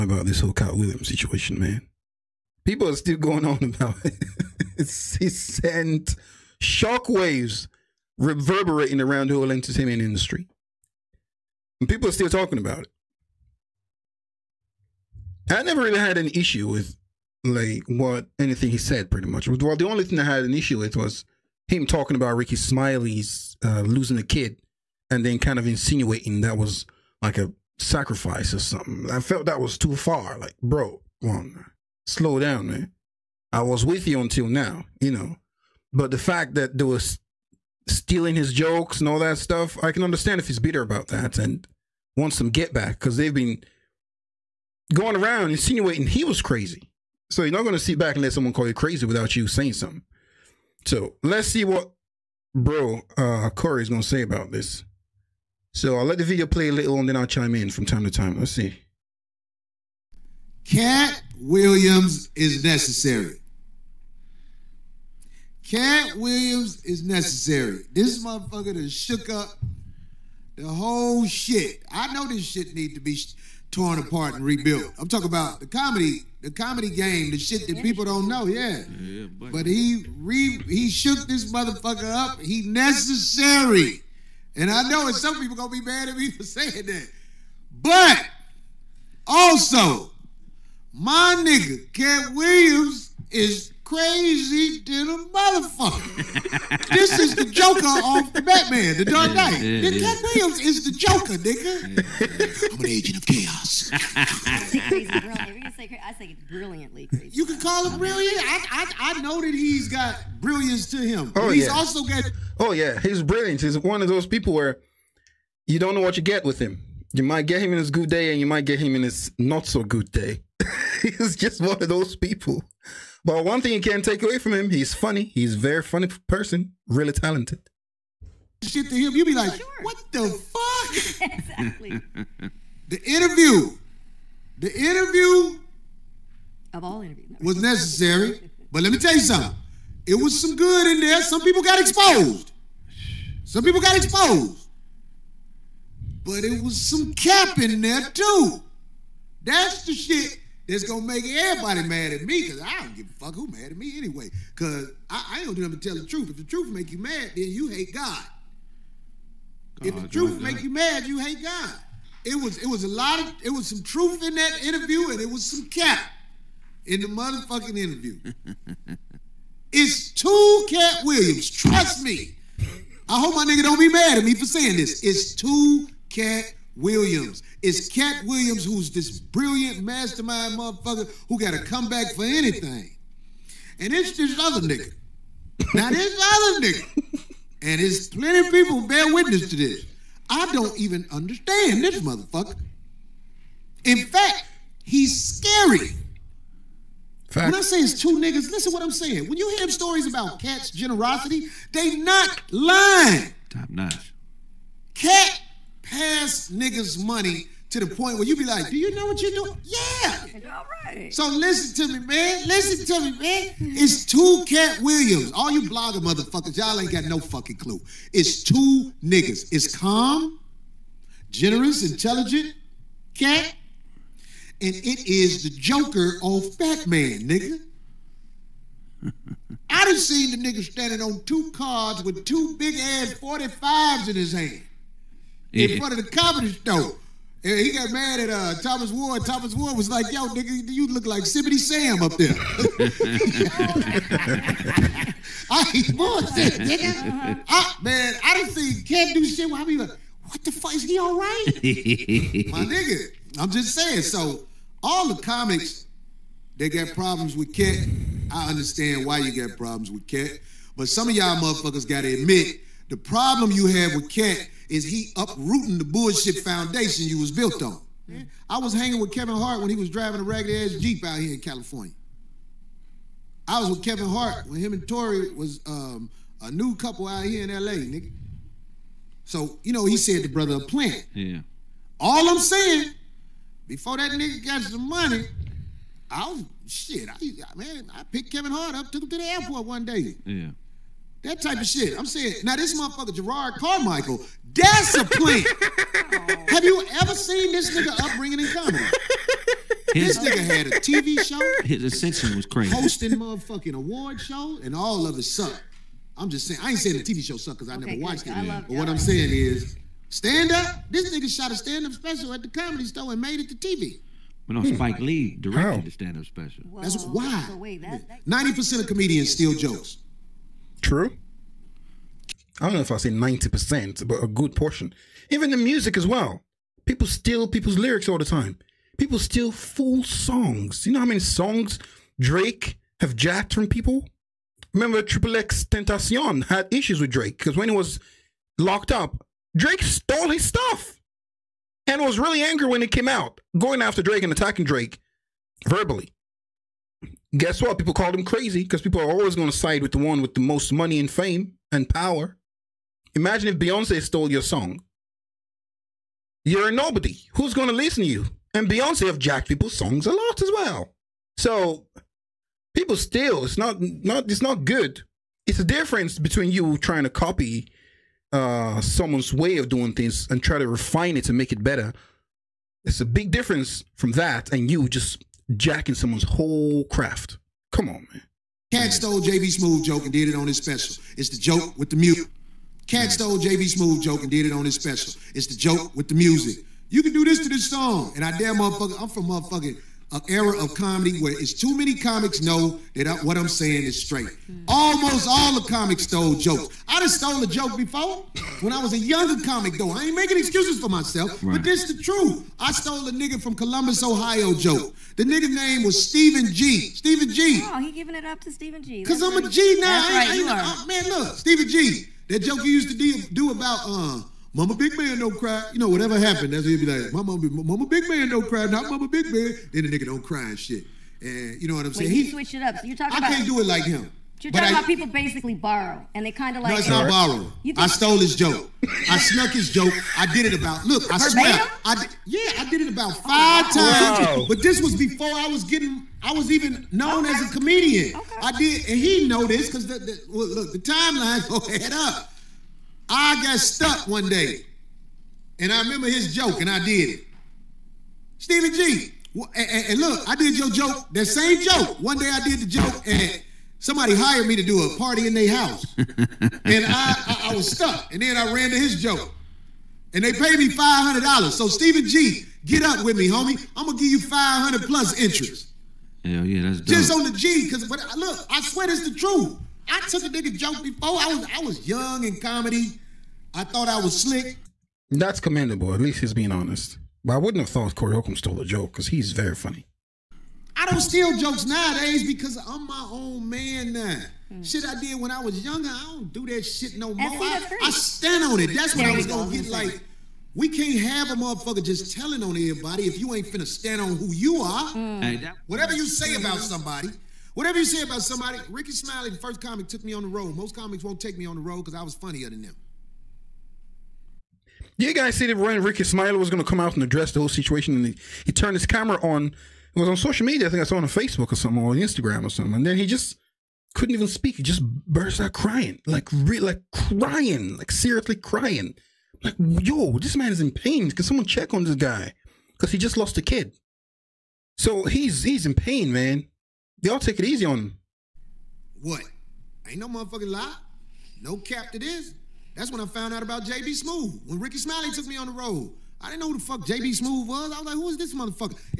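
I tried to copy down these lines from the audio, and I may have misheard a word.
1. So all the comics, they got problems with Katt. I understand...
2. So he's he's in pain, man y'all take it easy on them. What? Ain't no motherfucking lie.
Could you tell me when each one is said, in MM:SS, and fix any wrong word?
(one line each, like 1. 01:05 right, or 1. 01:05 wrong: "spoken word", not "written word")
1. 04:14 right
2. 08:44 right.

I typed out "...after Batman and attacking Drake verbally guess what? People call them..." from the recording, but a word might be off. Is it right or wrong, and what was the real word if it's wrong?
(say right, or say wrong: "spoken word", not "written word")
wrong: "Drake", not "Batman".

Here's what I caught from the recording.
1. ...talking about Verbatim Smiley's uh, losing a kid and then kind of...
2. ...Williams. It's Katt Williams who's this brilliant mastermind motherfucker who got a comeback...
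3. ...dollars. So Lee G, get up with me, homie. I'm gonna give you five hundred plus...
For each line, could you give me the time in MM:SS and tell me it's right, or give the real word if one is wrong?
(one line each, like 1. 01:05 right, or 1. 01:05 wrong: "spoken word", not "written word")
1. 00:21 wrong: "Rickey", not "Verbatim"
2. 02:56 right
3. 07:41 wrong: "Stephen", not "Lee".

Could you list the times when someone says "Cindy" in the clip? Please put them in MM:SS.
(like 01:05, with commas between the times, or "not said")
not said.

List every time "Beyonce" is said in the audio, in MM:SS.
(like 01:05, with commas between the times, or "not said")
05:53, 05:58.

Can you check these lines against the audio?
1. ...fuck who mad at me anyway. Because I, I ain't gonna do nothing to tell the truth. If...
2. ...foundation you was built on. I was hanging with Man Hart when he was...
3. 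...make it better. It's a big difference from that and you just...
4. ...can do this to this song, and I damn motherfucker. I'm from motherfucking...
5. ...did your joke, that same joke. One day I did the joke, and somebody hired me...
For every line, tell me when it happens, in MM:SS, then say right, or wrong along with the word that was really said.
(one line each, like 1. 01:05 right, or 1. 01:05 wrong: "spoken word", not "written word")
1. 02:33 right
2. 04:26 wrong: "Kevin", not "Man"
3. 06:11 right
4. 06:27 right
5. 07:30 right.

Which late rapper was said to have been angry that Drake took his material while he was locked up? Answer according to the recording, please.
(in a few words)
XXXTentacion.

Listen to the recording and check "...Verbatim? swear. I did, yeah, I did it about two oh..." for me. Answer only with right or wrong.
wrong.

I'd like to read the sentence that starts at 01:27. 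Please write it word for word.
But also, my nigga Katt Williams is crazy little motherfucker.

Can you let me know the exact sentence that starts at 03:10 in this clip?
I don't even understand this motherfucker.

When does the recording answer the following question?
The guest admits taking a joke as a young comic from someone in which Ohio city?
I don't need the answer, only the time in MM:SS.
06:43.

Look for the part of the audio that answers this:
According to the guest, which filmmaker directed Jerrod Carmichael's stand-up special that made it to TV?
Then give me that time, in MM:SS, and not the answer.
05:14.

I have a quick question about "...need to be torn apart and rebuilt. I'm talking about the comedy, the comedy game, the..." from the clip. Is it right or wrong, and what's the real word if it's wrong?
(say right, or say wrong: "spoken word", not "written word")
right.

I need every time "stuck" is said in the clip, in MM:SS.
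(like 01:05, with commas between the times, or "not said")
07:23, 07:37.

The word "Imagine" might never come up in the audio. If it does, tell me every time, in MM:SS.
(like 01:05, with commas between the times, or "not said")
05:53.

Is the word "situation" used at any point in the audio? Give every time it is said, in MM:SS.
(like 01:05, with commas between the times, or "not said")
00:01, 08:27.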